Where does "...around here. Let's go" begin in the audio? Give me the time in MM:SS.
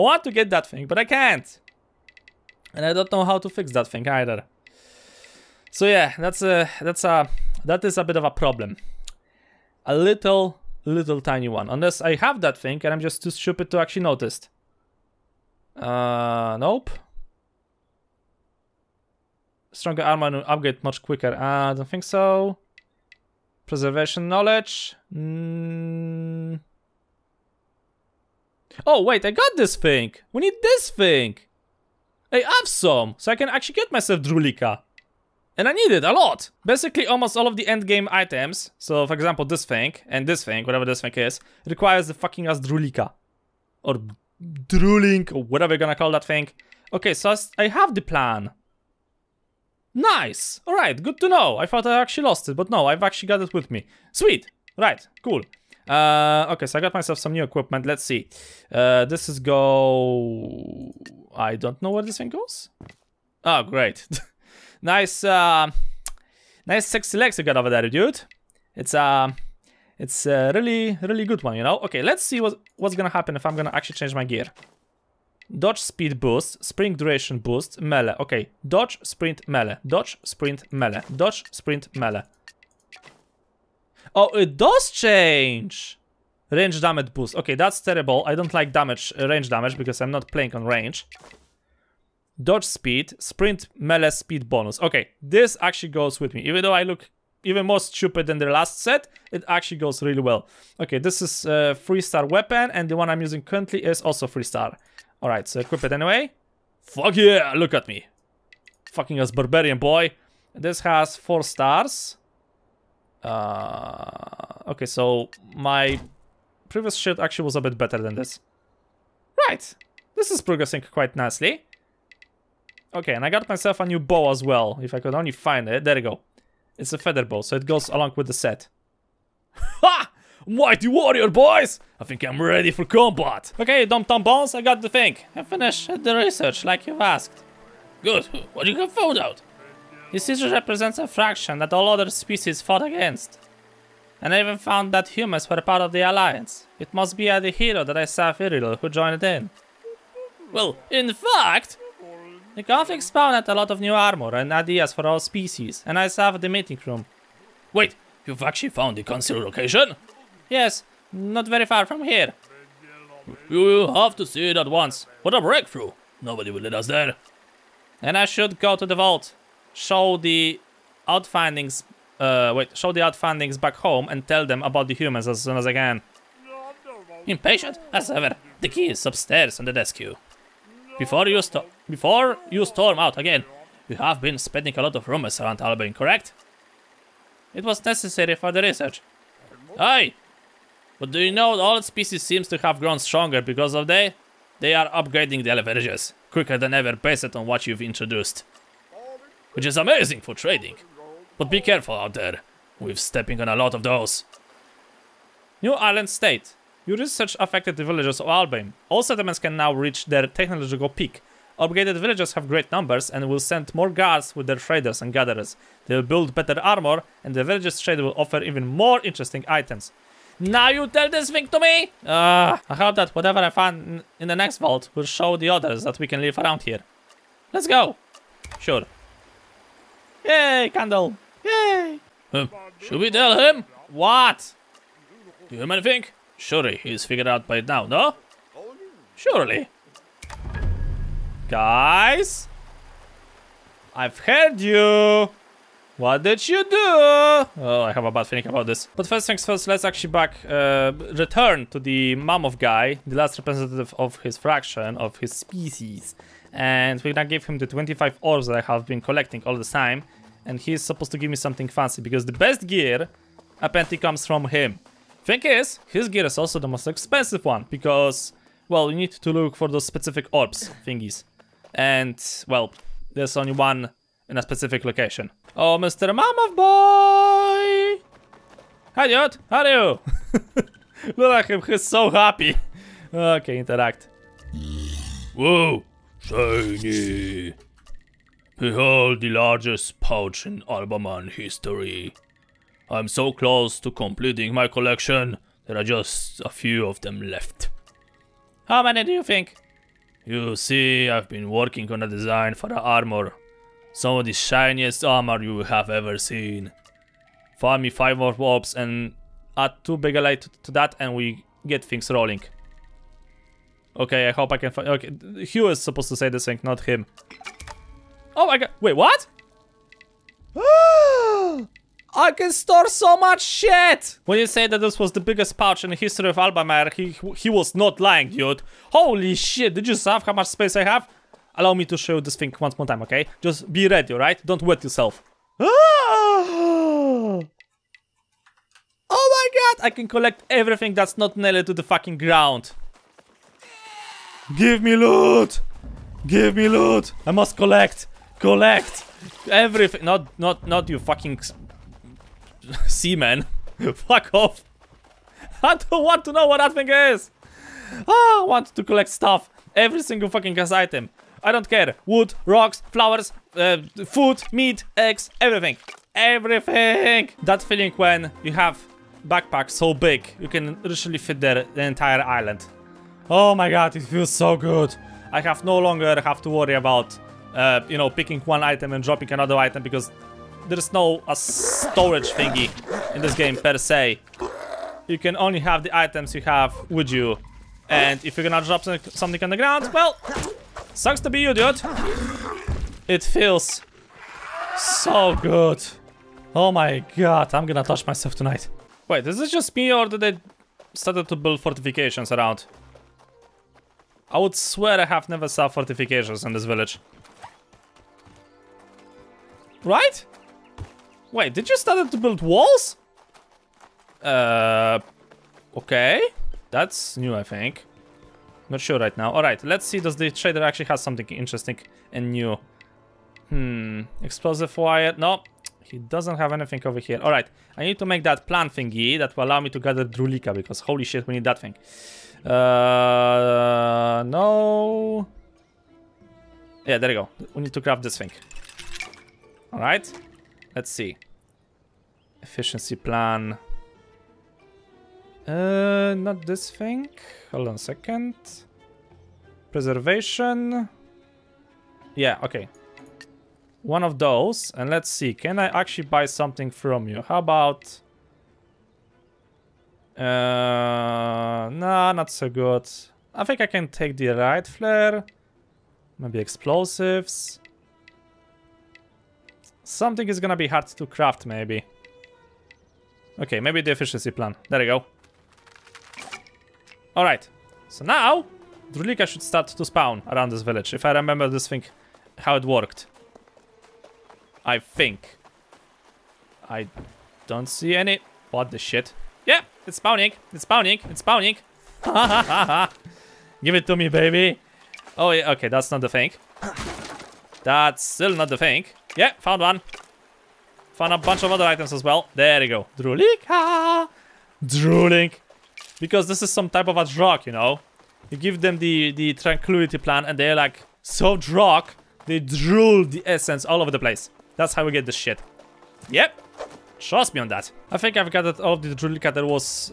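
03:46.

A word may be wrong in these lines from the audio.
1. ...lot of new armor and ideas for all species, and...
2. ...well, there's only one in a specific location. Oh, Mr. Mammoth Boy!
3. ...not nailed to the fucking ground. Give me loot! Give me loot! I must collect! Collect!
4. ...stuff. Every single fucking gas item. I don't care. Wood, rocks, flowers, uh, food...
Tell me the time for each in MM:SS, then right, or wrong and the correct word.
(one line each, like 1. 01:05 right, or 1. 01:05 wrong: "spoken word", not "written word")
1. 02:33 right
2. 04:32 right
3. 05:41 right
4. 05:59 right.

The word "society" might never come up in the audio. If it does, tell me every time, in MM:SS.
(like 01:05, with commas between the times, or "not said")
not said.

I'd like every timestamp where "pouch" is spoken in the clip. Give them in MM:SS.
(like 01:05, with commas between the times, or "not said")
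04:49, 05:25.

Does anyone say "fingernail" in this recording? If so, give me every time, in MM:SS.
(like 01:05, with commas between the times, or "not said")
not said.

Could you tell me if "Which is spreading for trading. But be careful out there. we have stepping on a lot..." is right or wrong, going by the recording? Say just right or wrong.
wrong.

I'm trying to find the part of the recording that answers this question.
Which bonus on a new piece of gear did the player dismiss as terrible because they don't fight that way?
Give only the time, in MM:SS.
01:26.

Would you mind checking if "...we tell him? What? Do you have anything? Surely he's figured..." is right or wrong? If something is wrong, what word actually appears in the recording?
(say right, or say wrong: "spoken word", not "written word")
right.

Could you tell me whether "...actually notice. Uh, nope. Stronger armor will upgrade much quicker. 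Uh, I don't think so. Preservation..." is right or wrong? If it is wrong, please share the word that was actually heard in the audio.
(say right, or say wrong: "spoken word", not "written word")
right.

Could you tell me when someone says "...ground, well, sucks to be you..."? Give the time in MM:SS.
06:29.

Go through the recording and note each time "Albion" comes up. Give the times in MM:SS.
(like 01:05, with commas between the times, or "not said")
03:05, 03:28.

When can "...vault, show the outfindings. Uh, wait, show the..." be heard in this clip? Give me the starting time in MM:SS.
02:48.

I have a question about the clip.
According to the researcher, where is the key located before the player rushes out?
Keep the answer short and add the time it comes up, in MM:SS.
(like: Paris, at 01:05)
Upstairs on the desk, at 02:59.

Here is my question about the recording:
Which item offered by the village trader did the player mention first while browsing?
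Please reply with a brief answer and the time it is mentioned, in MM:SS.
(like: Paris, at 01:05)
Explosive wire, at 07:04.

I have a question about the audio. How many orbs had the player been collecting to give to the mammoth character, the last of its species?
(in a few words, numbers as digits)
25.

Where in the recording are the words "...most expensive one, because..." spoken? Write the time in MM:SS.
04:26.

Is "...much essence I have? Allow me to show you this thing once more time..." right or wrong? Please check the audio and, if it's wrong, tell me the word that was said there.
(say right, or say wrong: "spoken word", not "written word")
wrong: "space", not "essence".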